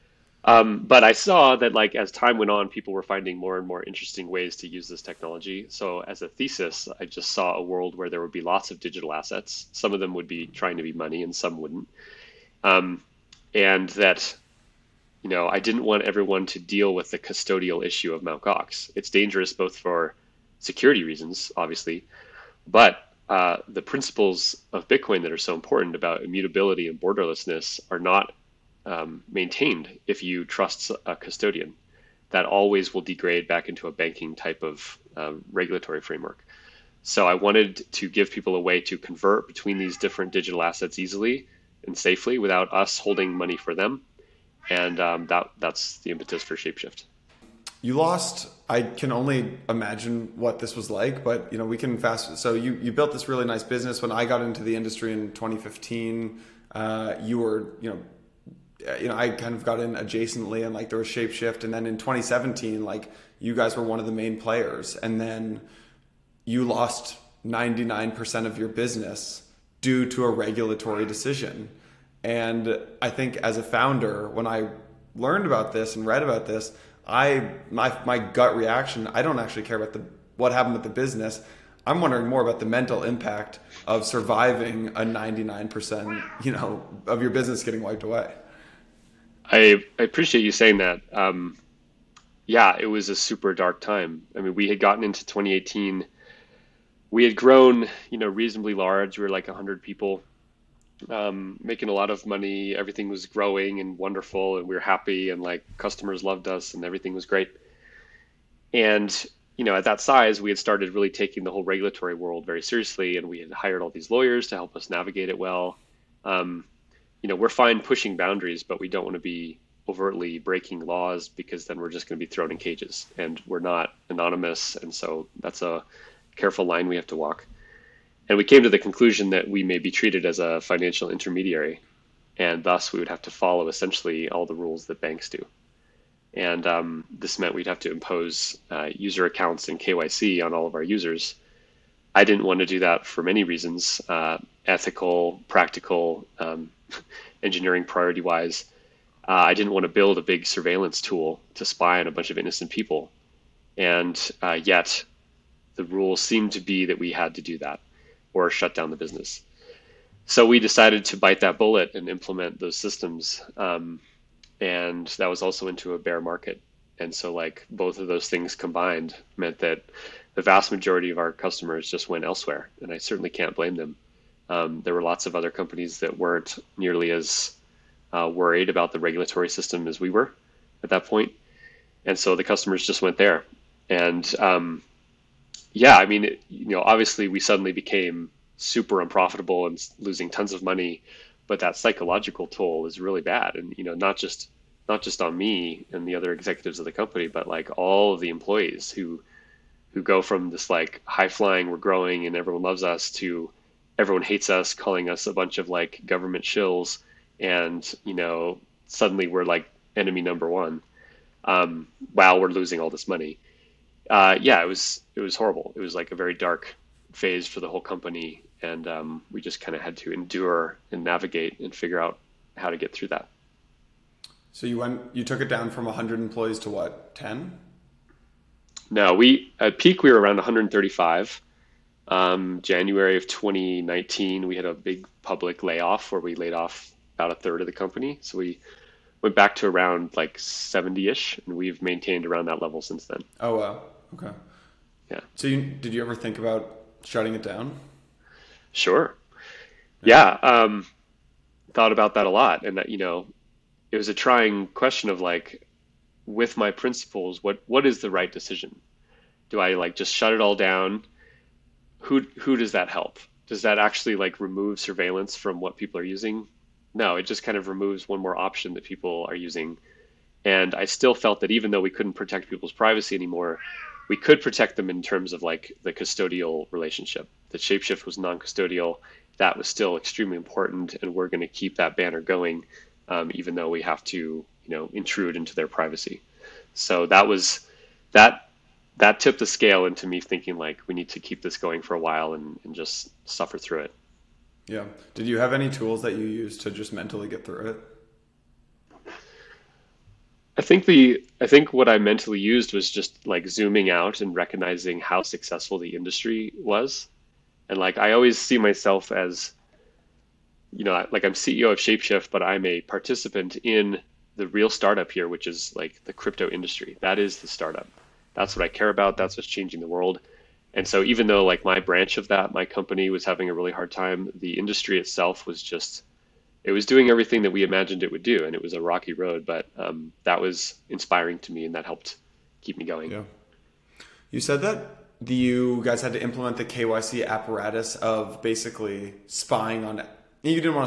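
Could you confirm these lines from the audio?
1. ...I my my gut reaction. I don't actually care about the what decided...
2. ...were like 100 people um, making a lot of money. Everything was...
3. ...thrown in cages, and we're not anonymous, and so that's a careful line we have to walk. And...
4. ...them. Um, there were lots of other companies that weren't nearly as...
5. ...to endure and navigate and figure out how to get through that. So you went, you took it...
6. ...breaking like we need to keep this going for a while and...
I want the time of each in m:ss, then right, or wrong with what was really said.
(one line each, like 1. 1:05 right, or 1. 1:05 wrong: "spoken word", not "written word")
1. 1:17 wrong: "happened", not "decided"
2. 1:39 right
3. 2:02 right
4. 2:53 right
5. 3:39 right
6. 4:50 wrong: "thinking", not "breaking".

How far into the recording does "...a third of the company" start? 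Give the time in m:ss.
3:57.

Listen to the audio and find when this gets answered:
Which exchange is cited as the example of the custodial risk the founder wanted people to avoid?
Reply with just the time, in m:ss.
0:18.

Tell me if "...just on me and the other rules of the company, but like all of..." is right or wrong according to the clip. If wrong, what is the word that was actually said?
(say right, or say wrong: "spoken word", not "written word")
wrong: "executives", not "rules".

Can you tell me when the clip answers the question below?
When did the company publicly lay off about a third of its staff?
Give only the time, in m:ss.
3:52.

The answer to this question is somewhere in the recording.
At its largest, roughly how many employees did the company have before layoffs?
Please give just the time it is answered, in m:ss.
3:50.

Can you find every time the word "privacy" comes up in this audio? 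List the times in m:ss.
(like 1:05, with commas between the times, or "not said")
4:32, 4:45.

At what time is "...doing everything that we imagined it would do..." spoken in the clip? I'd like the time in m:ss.
5:26.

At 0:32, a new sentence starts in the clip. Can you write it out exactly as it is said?
That always will degrade back into a banking type of uh, regulatory framework.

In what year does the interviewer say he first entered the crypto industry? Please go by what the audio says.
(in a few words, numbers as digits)
2015.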